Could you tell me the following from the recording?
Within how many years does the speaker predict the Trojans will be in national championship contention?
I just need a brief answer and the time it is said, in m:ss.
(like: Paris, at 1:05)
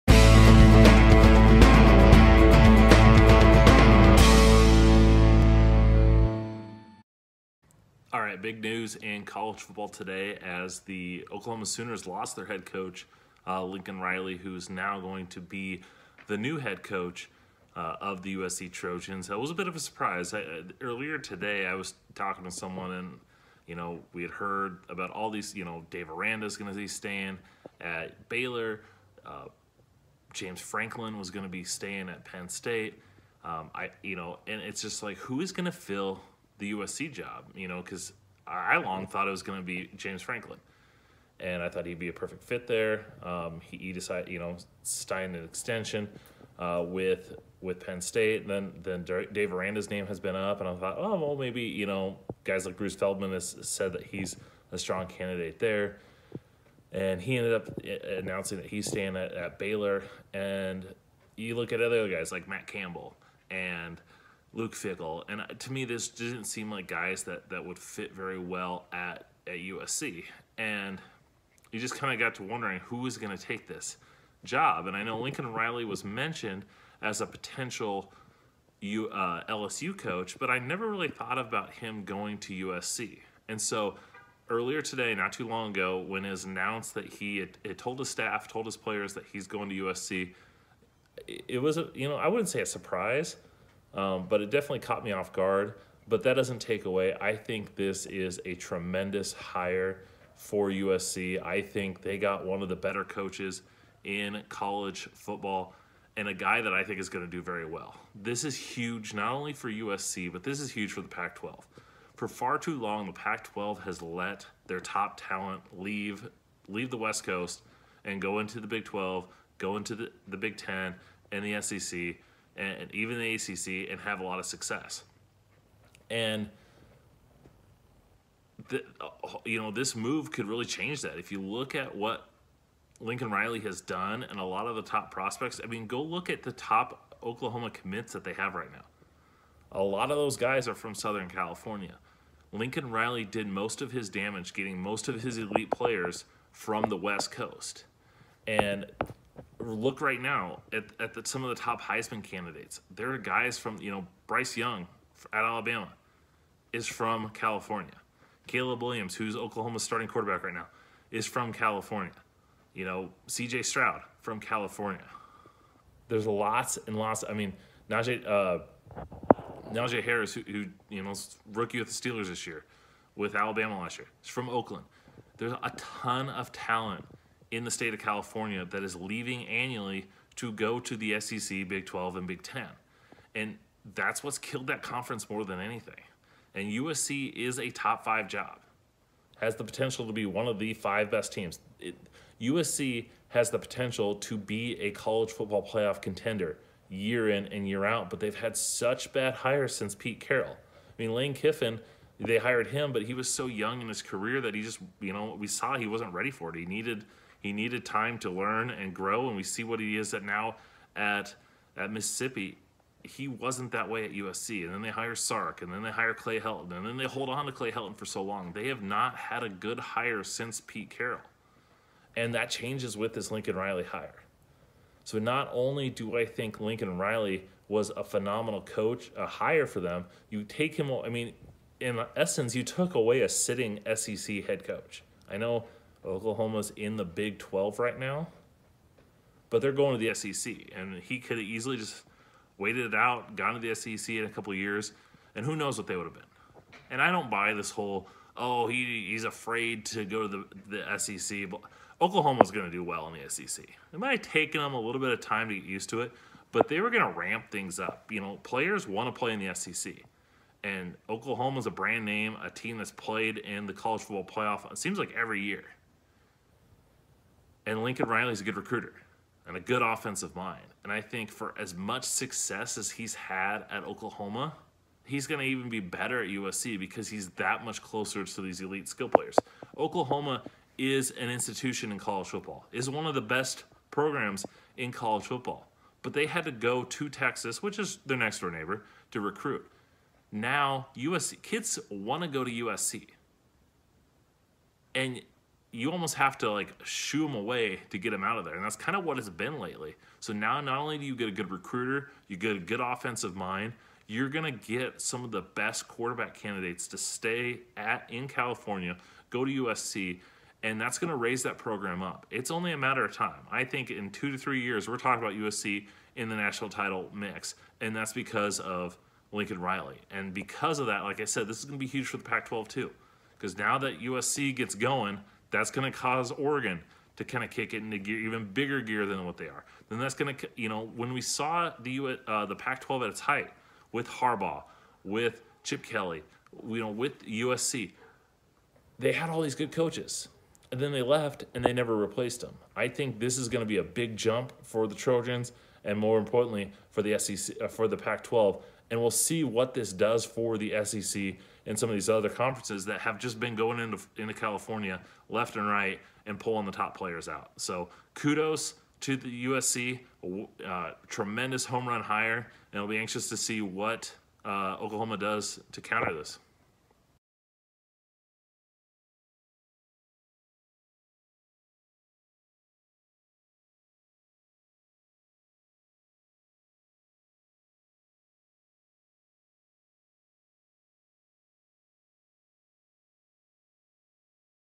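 2 to 3 years, at 5:14.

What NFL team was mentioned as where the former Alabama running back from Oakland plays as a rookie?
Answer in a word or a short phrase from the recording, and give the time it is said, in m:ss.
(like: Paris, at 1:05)
Steelers, at 2:51.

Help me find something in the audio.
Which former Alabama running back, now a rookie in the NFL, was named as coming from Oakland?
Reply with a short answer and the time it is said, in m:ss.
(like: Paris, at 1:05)
Najee Harris, at 2:49.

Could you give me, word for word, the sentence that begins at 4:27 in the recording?
And Lincoln Riley's a good recruiter and a good offensive mind.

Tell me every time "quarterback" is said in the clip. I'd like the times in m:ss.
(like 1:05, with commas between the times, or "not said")
2:40, 5:05.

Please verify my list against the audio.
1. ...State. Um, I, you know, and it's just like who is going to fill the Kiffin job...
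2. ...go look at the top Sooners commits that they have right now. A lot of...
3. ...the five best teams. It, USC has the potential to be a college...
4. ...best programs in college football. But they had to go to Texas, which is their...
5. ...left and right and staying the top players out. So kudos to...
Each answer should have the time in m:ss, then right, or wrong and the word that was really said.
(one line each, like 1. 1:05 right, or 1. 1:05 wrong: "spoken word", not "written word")
1. 0:32 wrong: "USC", not "Kiffin"
2. 2:15 wrong: "Oklahoma", not "Sooners"
3. 3:10 right
4. 4:43 right
5. 5:55 wrong: "pulling", not "staying".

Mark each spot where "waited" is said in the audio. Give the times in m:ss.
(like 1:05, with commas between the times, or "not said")
4:02.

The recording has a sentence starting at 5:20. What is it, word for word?
And because of that, like I said, this is going to be huge for the Pac-12 too.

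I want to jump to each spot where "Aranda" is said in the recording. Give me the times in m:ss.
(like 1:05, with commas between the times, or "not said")
0:26, 0:49.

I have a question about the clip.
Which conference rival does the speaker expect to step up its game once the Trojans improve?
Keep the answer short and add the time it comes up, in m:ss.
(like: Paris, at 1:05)
Oregon, at 5:26.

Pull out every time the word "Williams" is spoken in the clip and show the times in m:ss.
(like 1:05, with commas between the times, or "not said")
2:38.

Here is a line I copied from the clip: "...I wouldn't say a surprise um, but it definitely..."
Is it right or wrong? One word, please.
right.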